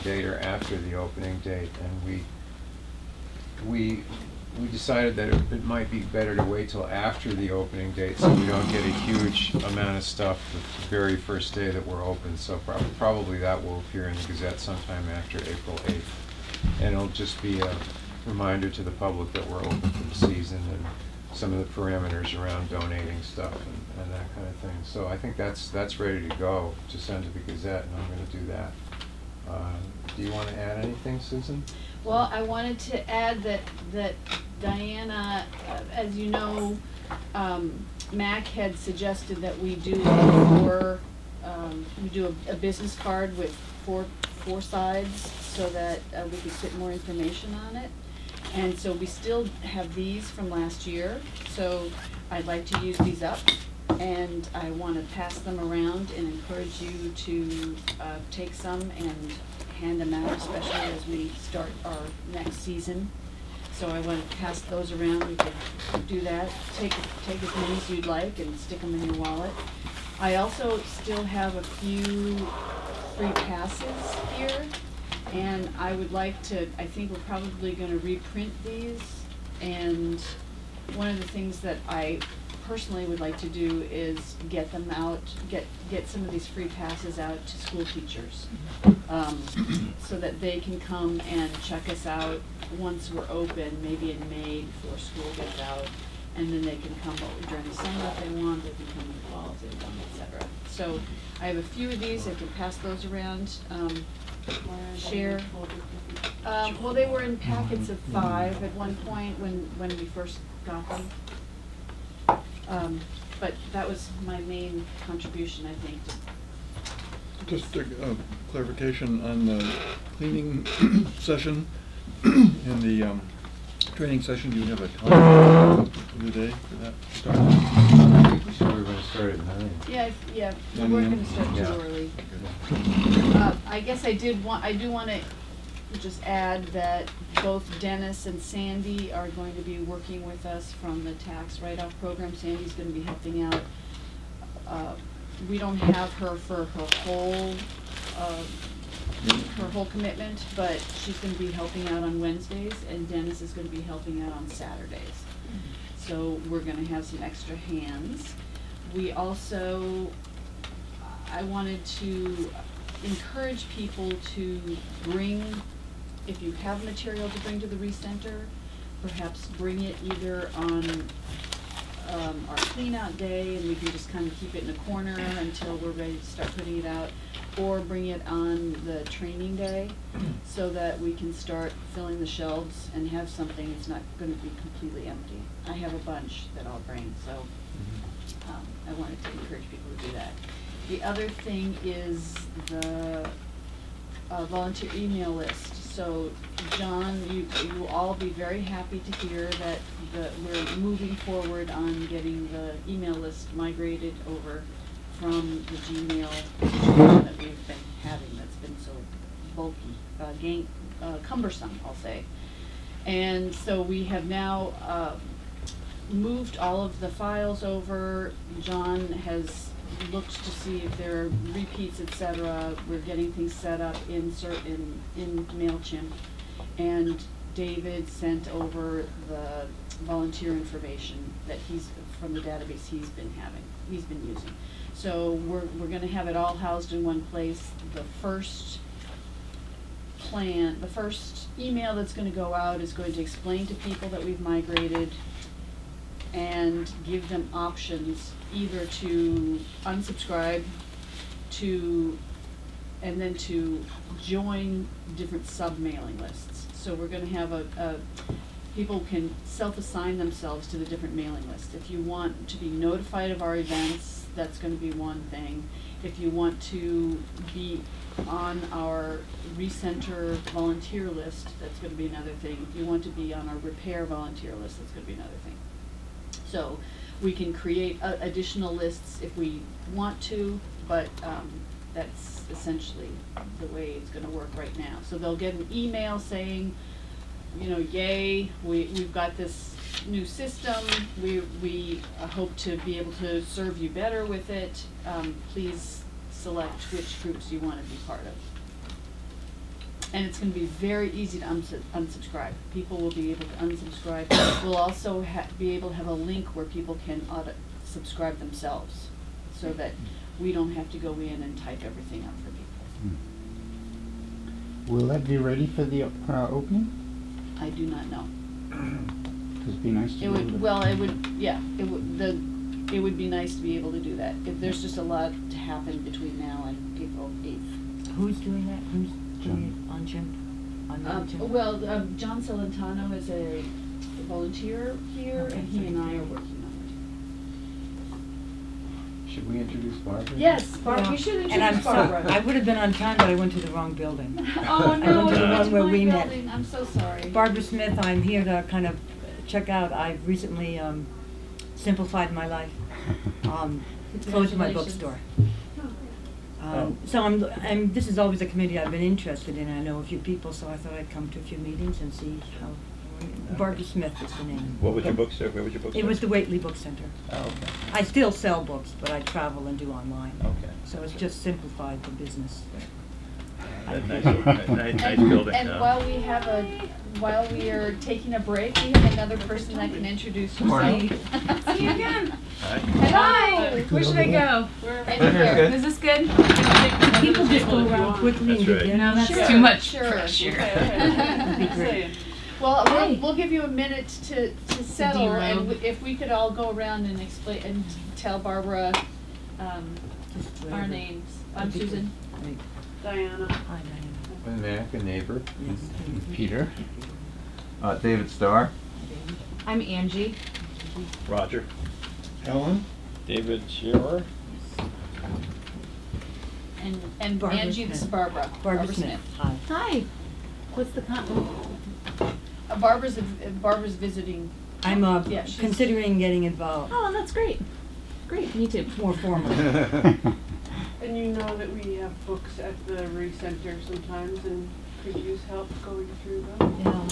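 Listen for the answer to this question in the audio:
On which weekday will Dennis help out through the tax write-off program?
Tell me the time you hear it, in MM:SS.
02:34.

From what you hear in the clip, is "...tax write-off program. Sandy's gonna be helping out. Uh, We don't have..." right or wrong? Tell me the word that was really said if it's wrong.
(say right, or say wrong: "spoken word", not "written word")
right.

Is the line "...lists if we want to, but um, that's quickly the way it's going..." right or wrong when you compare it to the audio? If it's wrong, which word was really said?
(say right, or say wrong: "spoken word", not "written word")
wrong: "essentially", not "quickly".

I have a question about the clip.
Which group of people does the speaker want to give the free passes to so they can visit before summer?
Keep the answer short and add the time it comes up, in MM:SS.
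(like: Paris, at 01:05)
school teachers, at 01:27.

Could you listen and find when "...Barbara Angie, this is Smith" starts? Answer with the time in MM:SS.
06:57.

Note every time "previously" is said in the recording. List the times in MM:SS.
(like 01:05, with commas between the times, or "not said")
not said.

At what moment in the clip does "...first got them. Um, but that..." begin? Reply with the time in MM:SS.
01:50.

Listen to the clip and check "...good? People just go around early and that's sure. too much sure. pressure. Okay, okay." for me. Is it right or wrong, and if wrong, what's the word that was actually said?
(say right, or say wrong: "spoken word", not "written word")
wrong: "quickly", not "early".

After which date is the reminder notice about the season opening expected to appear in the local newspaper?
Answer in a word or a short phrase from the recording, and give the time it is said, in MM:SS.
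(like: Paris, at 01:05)
April 8th, at 00:15.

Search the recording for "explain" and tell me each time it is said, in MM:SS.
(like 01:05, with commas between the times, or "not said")
04:03, 06:37.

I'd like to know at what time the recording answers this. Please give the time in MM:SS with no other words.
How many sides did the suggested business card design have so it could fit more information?
00:44.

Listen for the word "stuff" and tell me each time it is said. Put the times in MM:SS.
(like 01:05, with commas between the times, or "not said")
00:10, 00:23.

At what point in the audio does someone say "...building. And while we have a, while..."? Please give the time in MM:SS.
06:15.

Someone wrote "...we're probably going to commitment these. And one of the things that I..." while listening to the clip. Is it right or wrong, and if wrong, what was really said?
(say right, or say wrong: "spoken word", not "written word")
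wrong: "reprint", not "commitment".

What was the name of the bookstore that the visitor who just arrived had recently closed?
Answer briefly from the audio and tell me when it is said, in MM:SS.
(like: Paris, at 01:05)
Whately Book Center, at 06:06.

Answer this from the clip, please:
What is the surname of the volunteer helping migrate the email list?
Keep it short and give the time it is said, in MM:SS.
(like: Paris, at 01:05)
Celentano, at 05:32.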